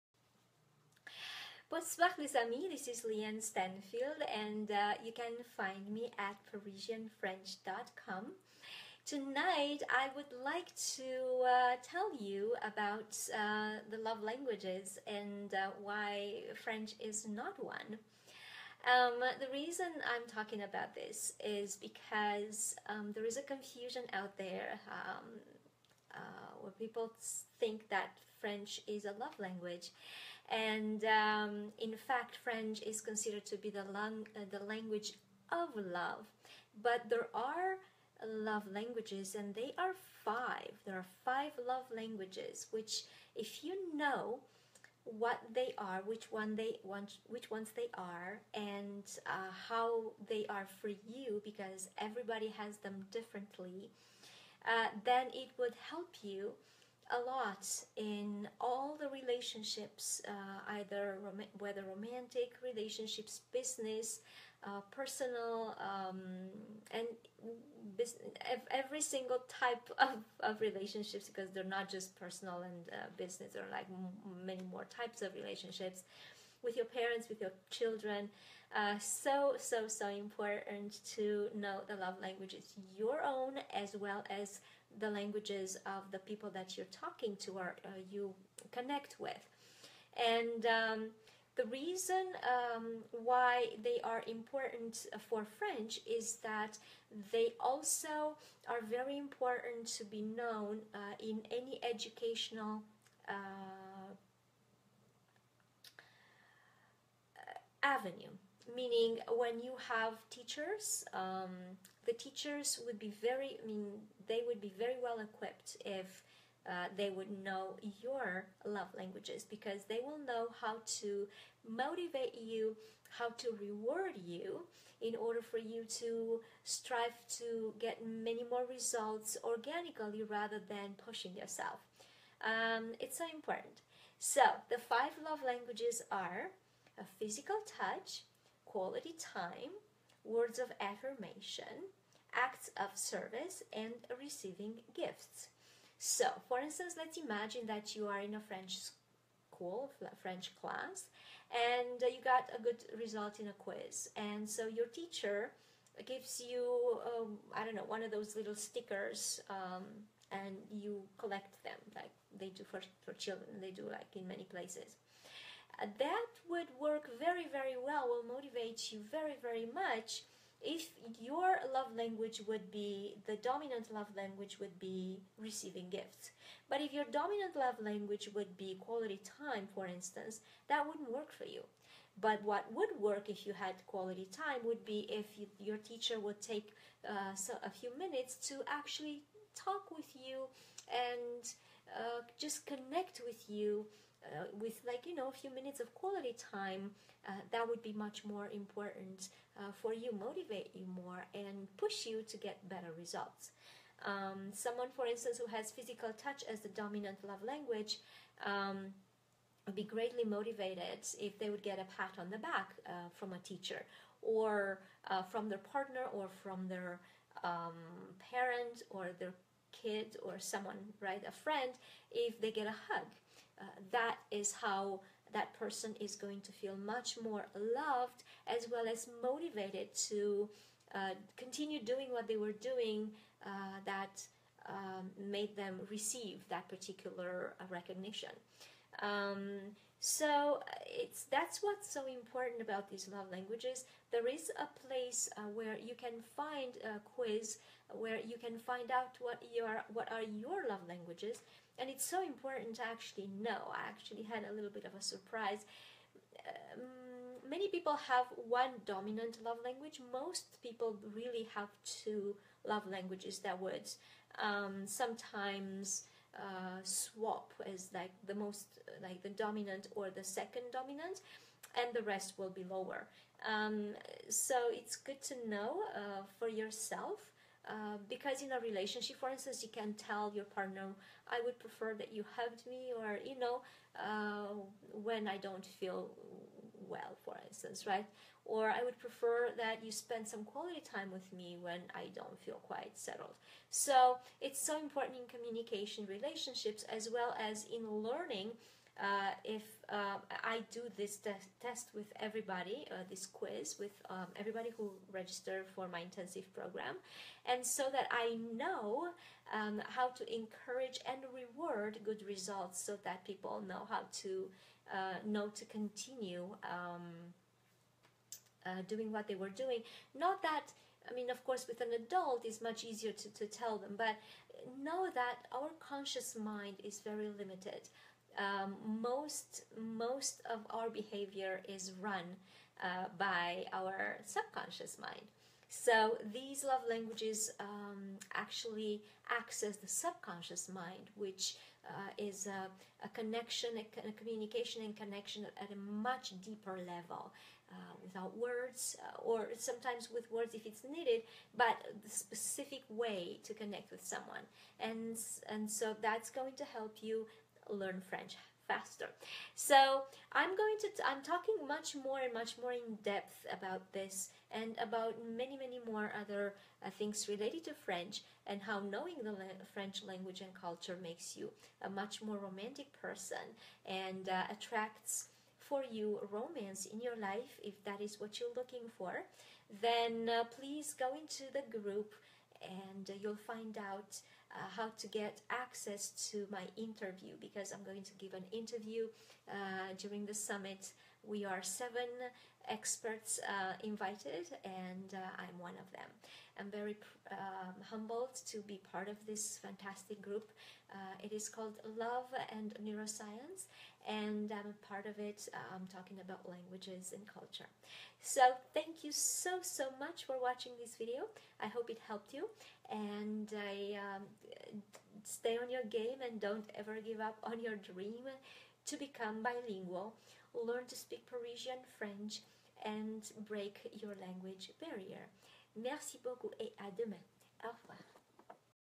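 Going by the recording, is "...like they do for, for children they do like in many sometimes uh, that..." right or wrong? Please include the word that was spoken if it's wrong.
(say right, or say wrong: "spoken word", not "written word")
wrong: "places", not "sometimes".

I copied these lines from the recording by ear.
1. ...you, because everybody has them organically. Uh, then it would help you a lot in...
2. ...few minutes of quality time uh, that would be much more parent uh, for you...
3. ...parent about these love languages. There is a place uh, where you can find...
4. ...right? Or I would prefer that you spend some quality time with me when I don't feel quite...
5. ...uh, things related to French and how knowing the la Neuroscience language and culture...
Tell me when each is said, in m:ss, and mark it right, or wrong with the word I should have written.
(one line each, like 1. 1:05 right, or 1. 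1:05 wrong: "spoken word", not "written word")
1. 0:50 wrong: "differently", not "organically"
2. 3:15 wrong: "important", not "parent"
3. 4:02 wrong: "important", not "parent"
4. 4:47 right
5. 6:06 wrong: "French", not "Neuroscience".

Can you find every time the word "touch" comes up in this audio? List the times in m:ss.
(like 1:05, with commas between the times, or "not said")
2:17, 3:26.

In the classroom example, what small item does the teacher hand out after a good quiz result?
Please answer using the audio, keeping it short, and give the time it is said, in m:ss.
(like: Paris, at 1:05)
stickers, at 2:38.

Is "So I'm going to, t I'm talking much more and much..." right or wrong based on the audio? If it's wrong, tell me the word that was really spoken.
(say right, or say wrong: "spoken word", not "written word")
right.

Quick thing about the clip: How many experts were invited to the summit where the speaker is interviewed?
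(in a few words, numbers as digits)
7.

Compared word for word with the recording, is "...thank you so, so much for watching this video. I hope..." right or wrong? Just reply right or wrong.
right.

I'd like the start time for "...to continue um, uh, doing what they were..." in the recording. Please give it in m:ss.
5:15.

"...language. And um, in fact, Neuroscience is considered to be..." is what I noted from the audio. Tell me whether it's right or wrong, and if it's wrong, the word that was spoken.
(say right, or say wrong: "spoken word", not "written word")
wrong: "French", not "Neuroscience".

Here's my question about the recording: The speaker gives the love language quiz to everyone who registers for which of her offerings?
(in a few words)
intensive program.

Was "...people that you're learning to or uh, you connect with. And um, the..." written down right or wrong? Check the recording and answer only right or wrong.
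wrong.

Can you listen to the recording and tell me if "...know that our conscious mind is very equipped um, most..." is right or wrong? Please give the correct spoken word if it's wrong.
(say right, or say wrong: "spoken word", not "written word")
wrong: "limited", not "equipped".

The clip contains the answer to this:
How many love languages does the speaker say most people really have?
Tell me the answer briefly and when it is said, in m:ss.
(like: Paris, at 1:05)
2, at 4:21.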